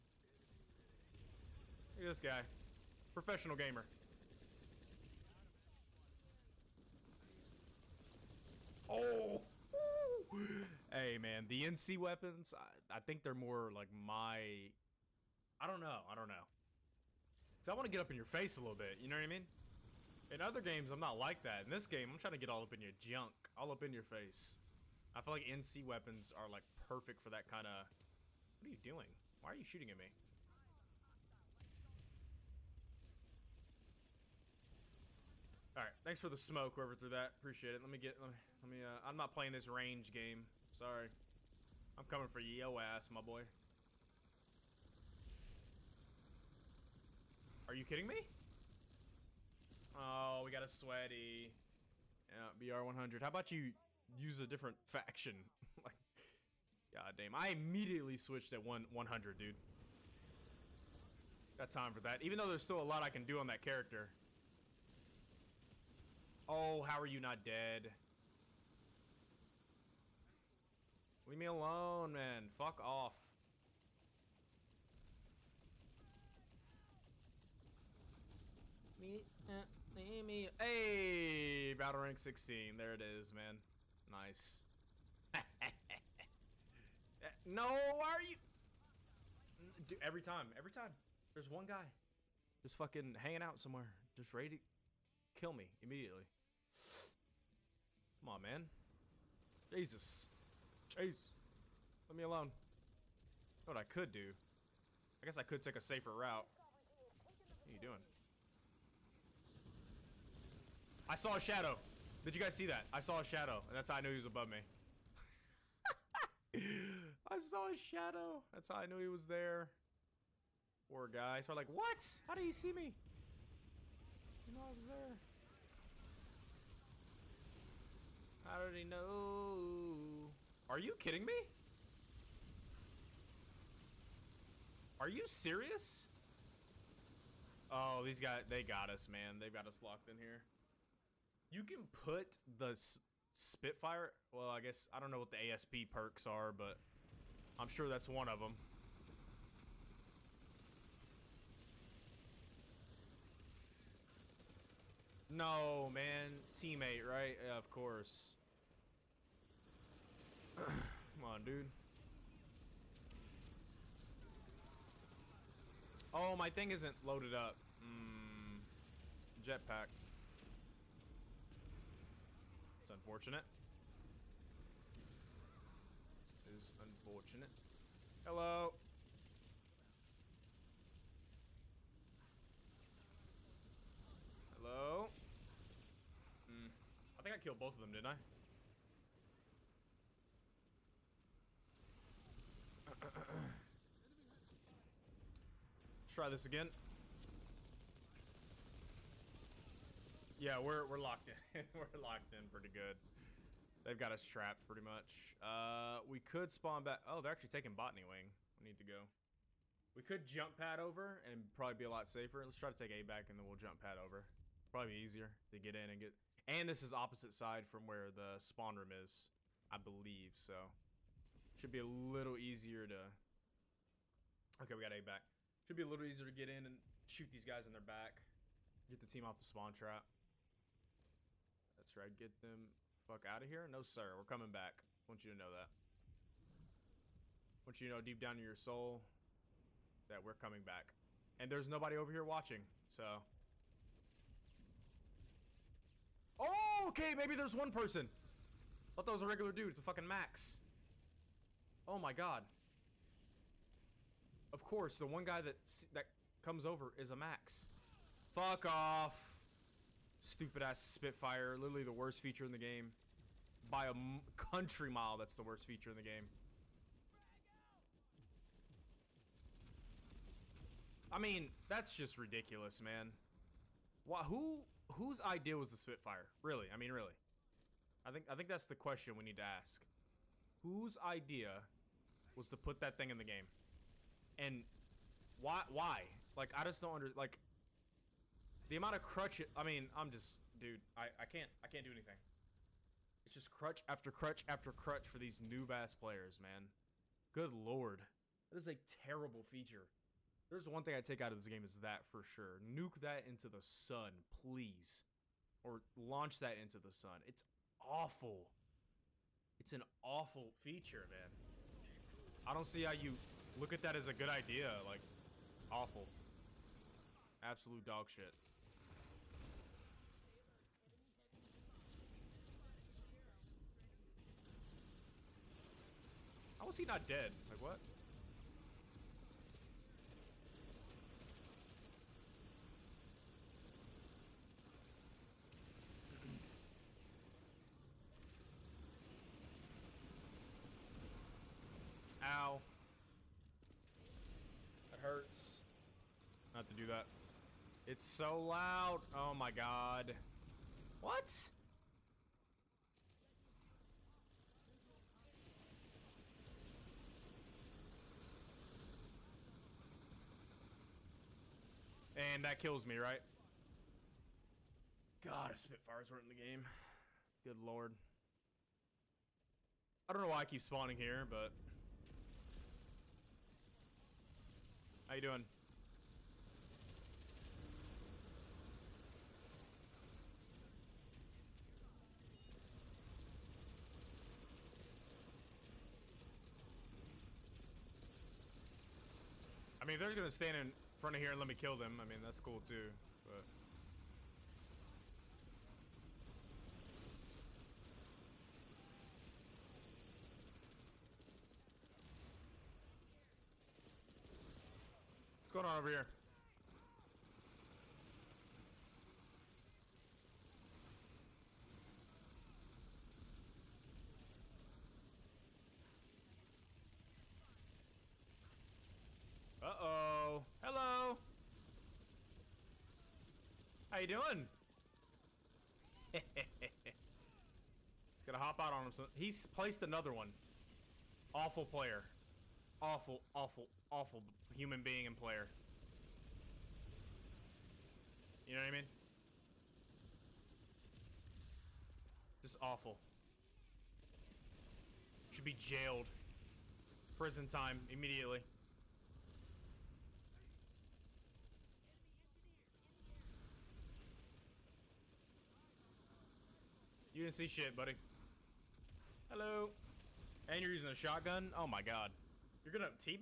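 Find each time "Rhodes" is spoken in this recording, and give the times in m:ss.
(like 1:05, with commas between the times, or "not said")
not said.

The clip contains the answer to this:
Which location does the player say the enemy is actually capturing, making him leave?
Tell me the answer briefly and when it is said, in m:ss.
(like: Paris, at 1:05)
Botany Wing, at 3:27.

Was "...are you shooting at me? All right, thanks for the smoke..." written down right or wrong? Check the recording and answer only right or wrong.
right.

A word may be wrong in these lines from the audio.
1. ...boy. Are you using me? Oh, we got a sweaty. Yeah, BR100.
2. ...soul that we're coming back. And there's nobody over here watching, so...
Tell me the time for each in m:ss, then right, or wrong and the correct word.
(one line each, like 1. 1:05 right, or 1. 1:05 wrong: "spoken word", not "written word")
1. 0:43 wrong: "kidding", not "using"
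2. 3:58 right.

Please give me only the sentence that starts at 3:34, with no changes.
Probably easier to get in and get...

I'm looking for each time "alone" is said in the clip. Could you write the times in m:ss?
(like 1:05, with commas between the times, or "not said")
1:11, 1:42.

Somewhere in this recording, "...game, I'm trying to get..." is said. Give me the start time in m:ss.
0:21.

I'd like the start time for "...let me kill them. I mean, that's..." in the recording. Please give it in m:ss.
6:31.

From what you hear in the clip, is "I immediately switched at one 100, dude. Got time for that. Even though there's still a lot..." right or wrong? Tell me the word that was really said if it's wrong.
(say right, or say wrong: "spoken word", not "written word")
right.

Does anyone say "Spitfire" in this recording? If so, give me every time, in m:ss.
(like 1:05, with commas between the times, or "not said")
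2:23, 4:20, 4:35, 6:05.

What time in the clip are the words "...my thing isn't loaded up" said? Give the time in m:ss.
2:46.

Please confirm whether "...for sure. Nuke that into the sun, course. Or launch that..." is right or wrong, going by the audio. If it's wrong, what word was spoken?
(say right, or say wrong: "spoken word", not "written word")
wrong: "please", not "course".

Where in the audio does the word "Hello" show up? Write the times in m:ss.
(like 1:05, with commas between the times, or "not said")
2:58, 3:04, 7:00, 7:39.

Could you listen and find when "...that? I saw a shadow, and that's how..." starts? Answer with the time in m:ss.
1:52.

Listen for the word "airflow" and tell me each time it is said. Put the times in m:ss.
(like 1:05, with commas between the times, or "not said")
not said.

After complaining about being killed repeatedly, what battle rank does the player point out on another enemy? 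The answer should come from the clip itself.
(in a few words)
16.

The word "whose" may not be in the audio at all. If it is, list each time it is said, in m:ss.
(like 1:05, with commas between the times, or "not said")
4:34, 4:40.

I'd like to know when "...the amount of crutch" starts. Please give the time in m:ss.
4:48.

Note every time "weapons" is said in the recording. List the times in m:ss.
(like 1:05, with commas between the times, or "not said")
0:11, 0:25.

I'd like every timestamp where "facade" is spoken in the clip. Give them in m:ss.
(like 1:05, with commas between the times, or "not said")
not said.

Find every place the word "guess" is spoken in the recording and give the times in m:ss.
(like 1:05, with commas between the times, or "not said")
1:45, 2:24.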